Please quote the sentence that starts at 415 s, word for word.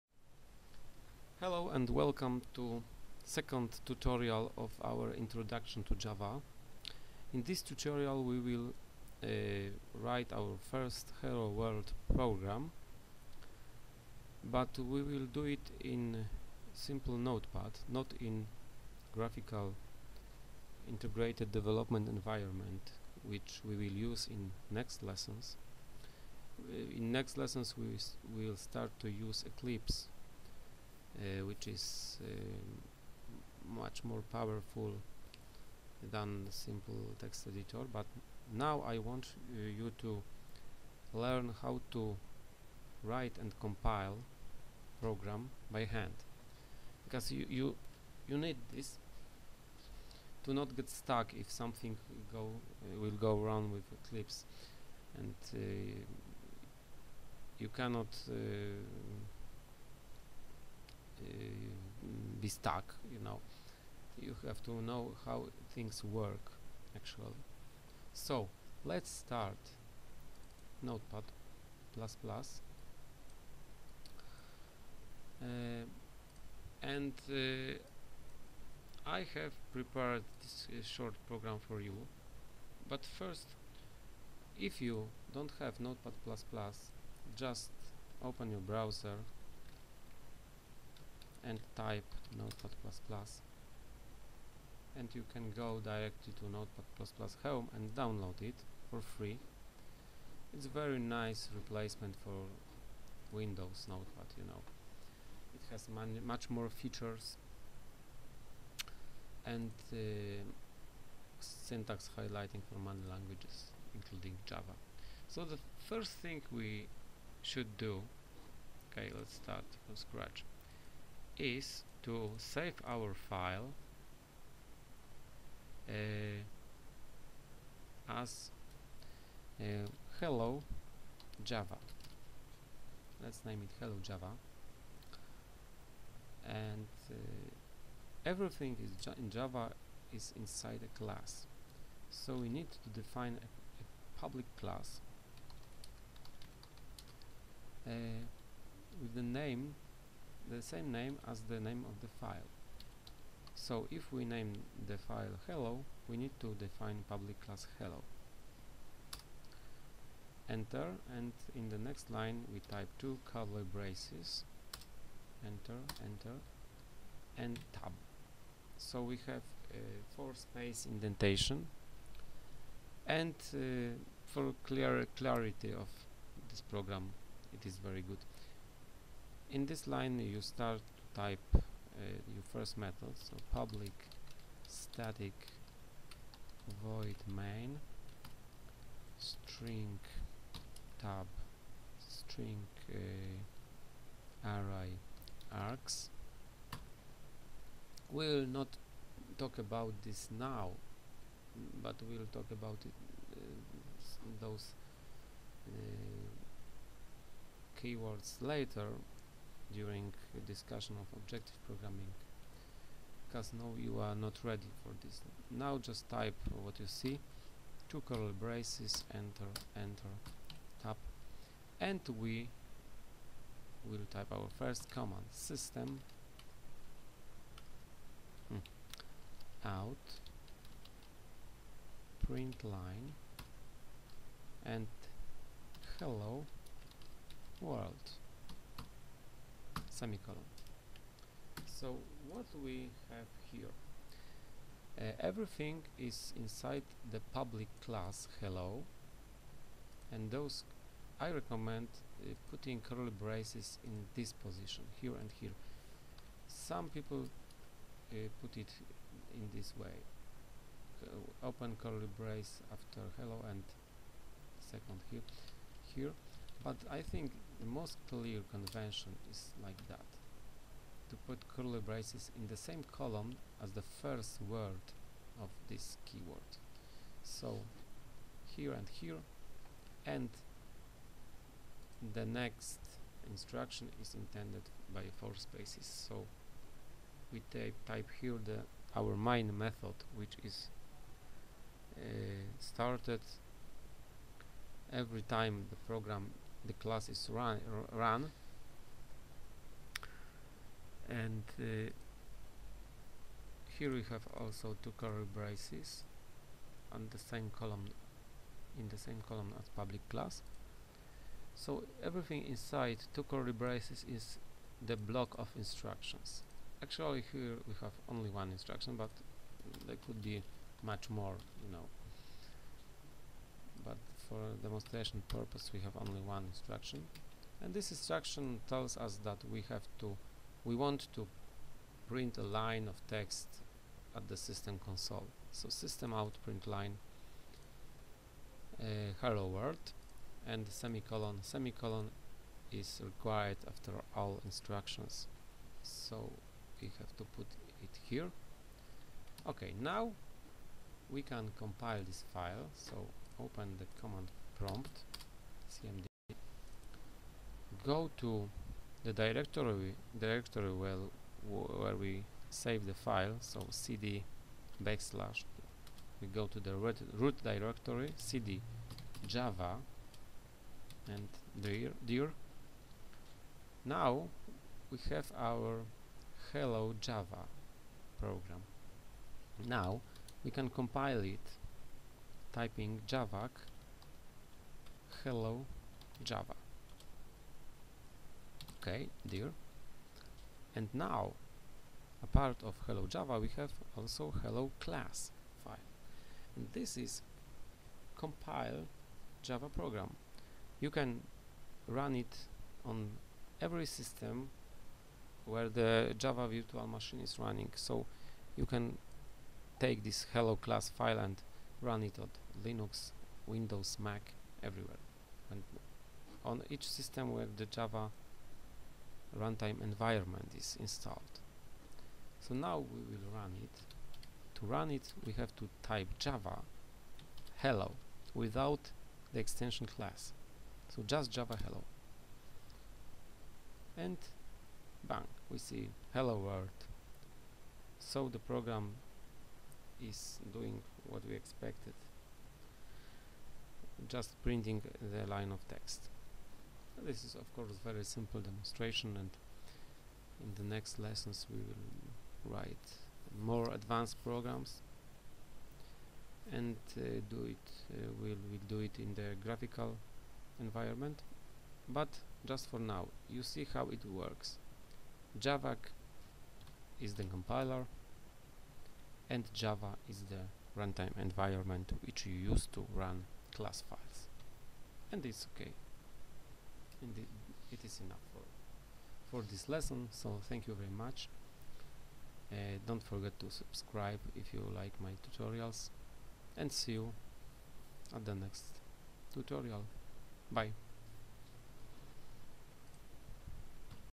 And on each system where the Java runtime environment is installed.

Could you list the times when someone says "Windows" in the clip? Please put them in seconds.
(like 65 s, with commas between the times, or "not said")
103 s, 413 s.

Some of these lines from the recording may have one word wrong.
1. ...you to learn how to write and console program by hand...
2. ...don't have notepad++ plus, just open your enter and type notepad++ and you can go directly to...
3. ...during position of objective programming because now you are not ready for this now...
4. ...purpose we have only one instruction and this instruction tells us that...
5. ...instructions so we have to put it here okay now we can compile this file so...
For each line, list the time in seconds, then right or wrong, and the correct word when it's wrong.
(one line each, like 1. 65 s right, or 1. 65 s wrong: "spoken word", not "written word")
1. 39 s wrong: "compile", not "console"
2. 85 s wrong: "browser", not "enter"
3. 209 s wrong: "discussion", not "position"
4. 325 s right
5. 344 s right.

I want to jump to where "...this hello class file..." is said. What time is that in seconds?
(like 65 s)
410 s.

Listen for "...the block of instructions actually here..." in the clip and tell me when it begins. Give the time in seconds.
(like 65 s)
314 s.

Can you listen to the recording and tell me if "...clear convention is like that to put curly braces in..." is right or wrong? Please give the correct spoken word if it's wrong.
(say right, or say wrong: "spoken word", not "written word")
right.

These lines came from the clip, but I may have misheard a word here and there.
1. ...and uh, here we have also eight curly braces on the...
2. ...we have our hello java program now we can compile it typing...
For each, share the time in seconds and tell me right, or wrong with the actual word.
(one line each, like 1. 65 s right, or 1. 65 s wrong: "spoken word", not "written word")
1. 301 s wrong: "two", not "eight"
2. 374 s right.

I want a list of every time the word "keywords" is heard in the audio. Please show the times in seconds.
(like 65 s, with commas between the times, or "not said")
207 s, 276 s.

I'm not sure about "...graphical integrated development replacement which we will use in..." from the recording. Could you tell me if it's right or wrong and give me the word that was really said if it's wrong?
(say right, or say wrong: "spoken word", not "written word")
wrong: "environment", not "replacement".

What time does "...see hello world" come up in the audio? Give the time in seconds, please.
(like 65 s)
435 s.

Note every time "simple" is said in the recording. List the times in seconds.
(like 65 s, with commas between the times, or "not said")
16 s, 36 s, 448 s.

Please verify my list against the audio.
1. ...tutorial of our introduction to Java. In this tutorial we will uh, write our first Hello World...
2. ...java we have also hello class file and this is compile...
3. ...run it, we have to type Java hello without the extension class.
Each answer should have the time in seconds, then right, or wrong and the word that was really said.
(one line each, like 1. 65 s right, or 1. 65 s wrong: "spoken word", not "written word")
1. 3 s right
2. 393 s right
3. 424 s right.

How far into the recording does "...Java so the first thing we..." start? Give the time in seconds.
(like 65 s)
114 s.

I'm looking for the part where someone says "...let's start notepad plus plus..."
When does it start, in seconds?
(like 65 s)
68 s.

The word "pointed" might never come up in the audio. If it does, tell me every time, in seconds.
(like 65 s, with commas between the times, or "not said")
not said.